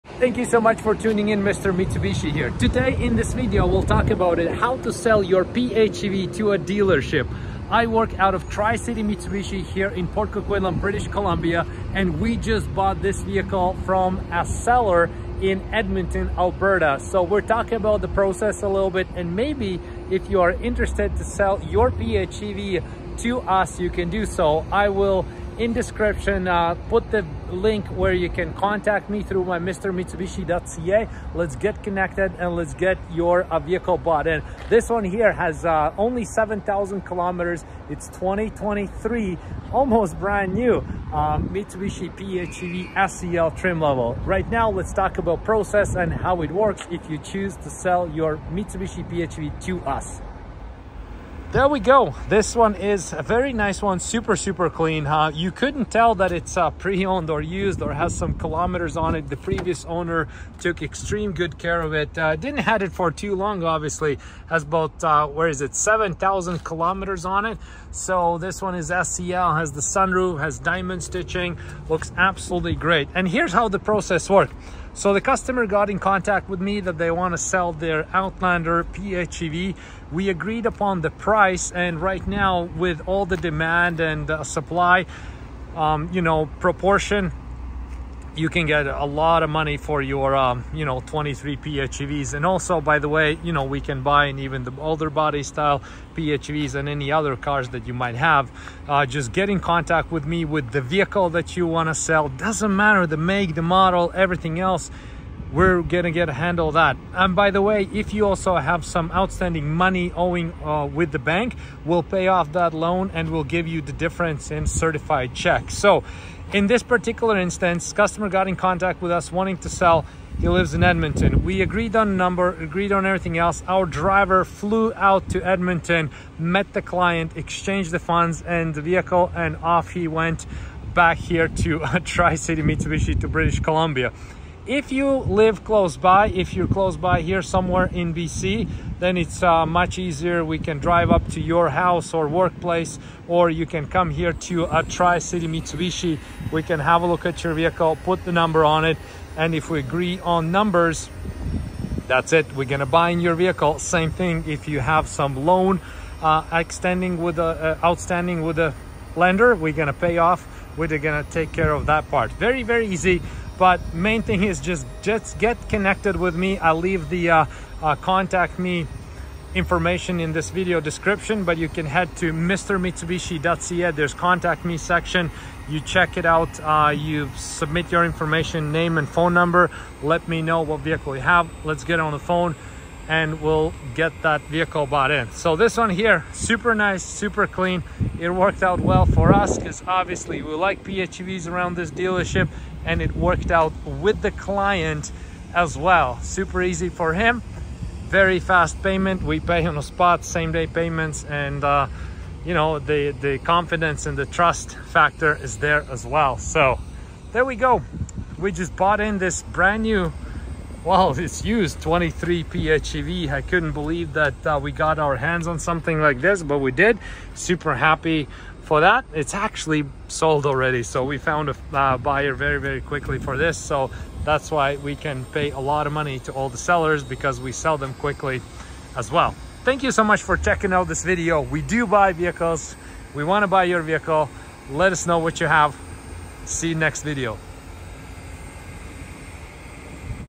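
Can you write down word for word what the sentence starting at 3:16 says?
Super easy for him, very fast payment.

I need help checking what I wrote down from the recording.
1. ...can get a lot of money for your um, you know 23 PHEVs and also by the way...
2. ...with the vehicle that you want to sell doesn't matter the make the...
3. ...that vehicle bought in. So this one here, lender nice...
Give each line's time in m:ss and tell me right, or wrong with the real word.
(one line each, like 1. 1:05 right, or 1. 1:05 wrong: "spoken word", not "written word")
1. 1:28 right
2. 1:40 right
3. 3:04 wrong: "super", not "lender".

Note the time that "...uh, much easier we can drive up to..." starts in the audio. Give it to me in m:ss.
2:19.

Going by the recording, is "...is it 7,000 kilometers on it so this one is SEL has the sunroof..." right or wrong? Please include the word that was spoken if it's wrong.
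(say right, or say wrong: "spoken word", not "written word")
right.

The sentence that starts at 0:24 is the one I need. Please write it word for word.
I will in description uh, put the link where you can contact me through my mrmitsubishi.ca.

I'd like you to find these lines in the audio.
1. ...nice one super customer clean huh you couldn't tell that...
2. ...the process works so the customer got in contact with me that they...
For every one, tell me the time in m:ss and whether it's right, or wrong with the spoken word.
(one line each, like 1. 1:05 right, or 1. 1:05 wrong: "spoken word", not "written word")
1. 0:53 wrong: "super", not "customer"
2. 1:13 right.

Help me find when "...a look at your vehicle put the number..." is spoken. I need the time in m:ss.
2:27.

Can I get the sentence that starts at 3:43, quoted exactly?
So that's why we can pay a lot of money to all the sellers because we sell them quickly as well.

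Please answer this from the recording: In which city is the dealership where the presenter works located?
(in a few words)
Port Coquitlam.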